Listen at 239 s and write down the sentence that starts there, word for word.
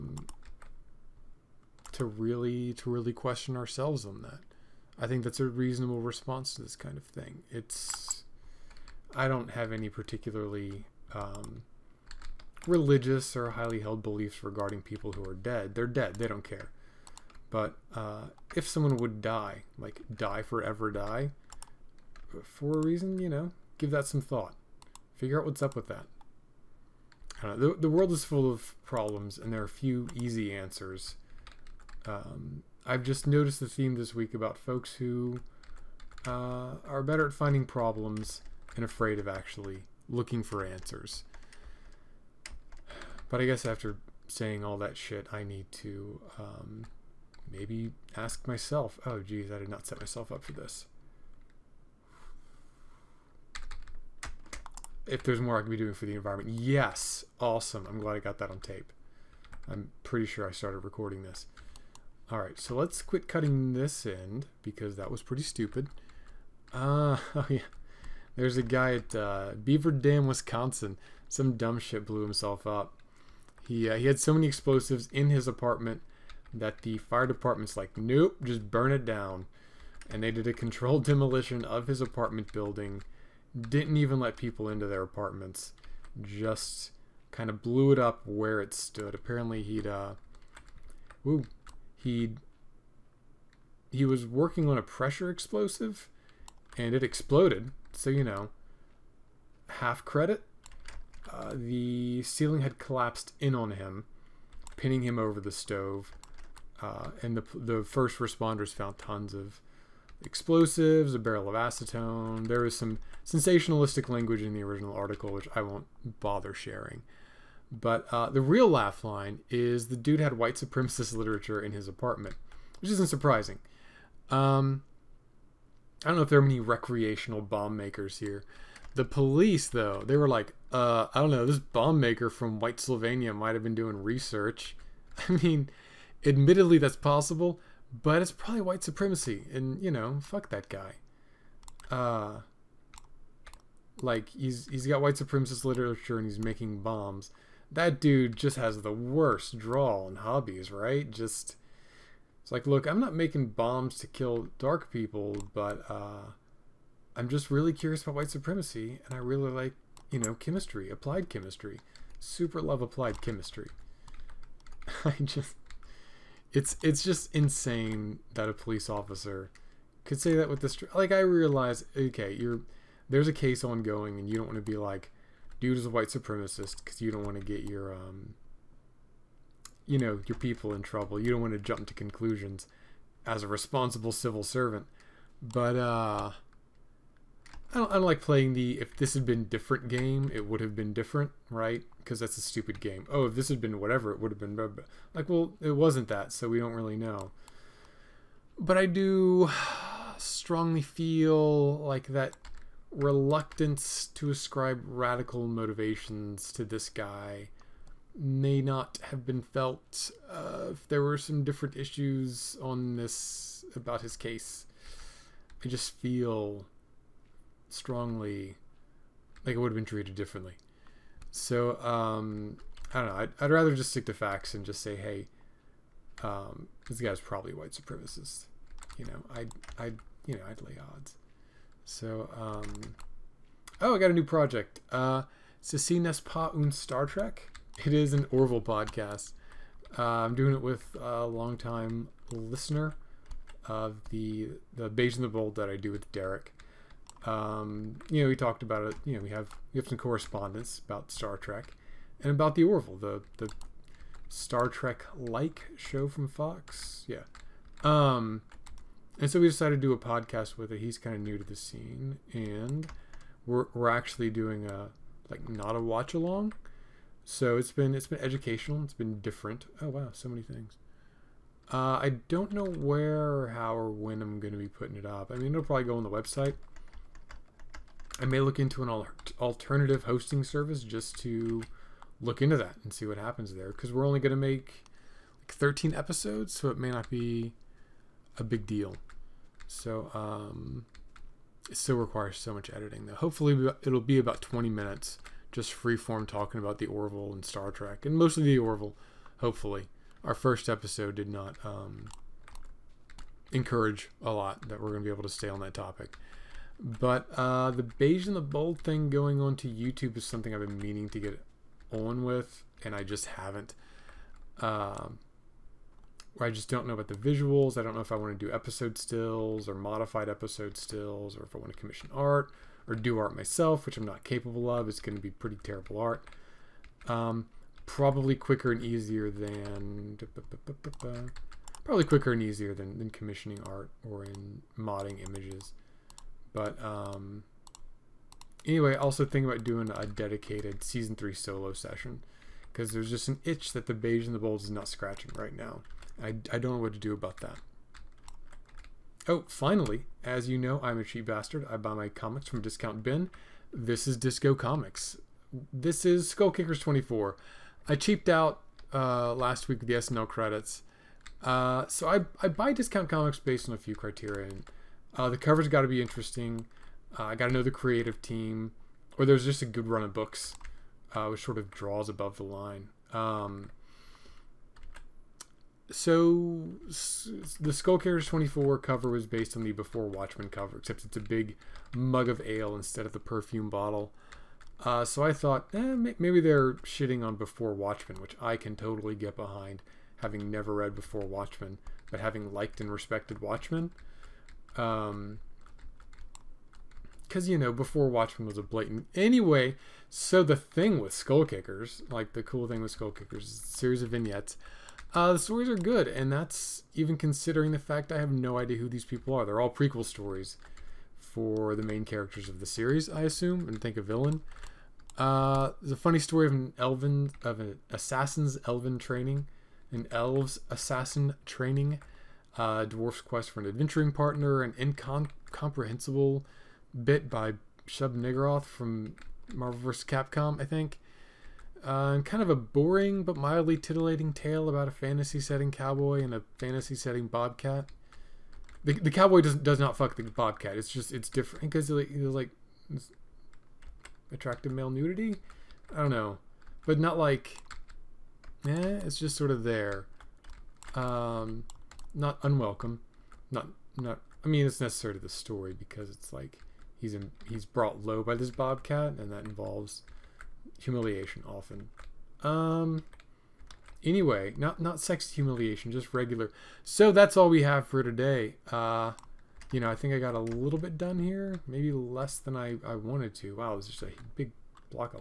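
Uh, I'm doing it with a longtime listener of the the Beige and the Bold that I do with Derek.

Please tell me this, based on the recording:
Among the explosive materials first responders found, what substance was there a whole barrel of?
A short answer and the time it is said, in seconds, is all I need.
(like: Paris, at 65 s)
acetone, at 111 s.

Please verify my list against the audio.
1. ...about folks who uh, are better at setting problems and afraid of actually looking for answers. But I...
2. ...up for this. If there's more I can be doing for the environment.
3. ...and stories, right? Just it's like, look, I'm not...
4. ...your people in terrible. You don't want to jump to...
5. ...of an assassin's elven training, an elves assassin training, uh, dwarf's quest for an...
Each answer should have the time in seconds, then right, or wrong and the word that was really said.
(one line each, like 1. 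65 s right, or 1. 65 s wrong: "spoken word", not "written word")
1. 34 s wrong: "finding", not "setting"
2. 50 s right
3. 150 s wrong: "hobbies", not "stories"
4. 180 s wrong: "trouble", not "terrible"
5. 417 s right.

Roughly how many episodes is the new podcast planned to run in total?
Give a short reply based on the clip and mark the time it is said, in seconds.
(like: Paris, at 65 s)
13, at 285 s.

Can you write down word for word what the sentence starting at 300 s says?
Our first episode did not um, encourage a lot that we're going to be able to stay on that topic.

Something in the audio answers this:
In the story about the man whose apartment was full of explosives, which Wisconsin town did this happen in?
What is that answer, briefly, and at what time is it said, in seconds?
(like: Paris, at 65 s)
Beaver Dam, at 69 s.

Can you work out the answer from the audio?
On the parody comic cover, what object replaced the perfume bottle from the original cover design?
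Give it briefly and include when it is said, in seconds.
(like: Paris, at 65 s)
mug of ale, at 381 s.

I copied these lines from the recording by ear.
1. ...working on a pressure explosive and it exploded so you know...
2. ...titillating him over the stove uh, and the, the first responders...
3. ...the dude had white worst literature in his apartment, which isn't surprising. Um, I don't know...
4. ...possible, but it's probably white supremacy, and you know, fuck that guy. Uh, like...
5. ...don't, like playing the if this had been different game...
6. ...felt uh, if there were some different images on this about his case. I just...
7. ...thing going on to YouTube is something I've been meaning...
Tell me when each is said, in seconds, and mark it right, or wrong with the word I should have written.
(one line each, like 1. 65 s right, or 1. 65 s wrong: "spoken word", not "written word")
1. 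94 s right
2. 104 s wrong: "pinning", not "titillating"
3. 119 s wrong: "supremacist", not "worst"
4. 136 s right
5. 187 s right
6. 209 s wrong: "issues", not "images"
7. 308 s right.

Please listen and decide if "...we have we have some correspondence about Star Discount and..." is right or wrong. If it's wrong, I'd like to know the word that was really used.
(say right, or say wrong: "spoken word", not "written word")
wrong: "Trek", not "Discount".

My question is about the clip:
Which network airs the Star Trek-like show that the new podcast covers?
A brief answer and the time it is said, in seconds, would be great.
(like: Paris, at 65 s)
Fox, at 256 s.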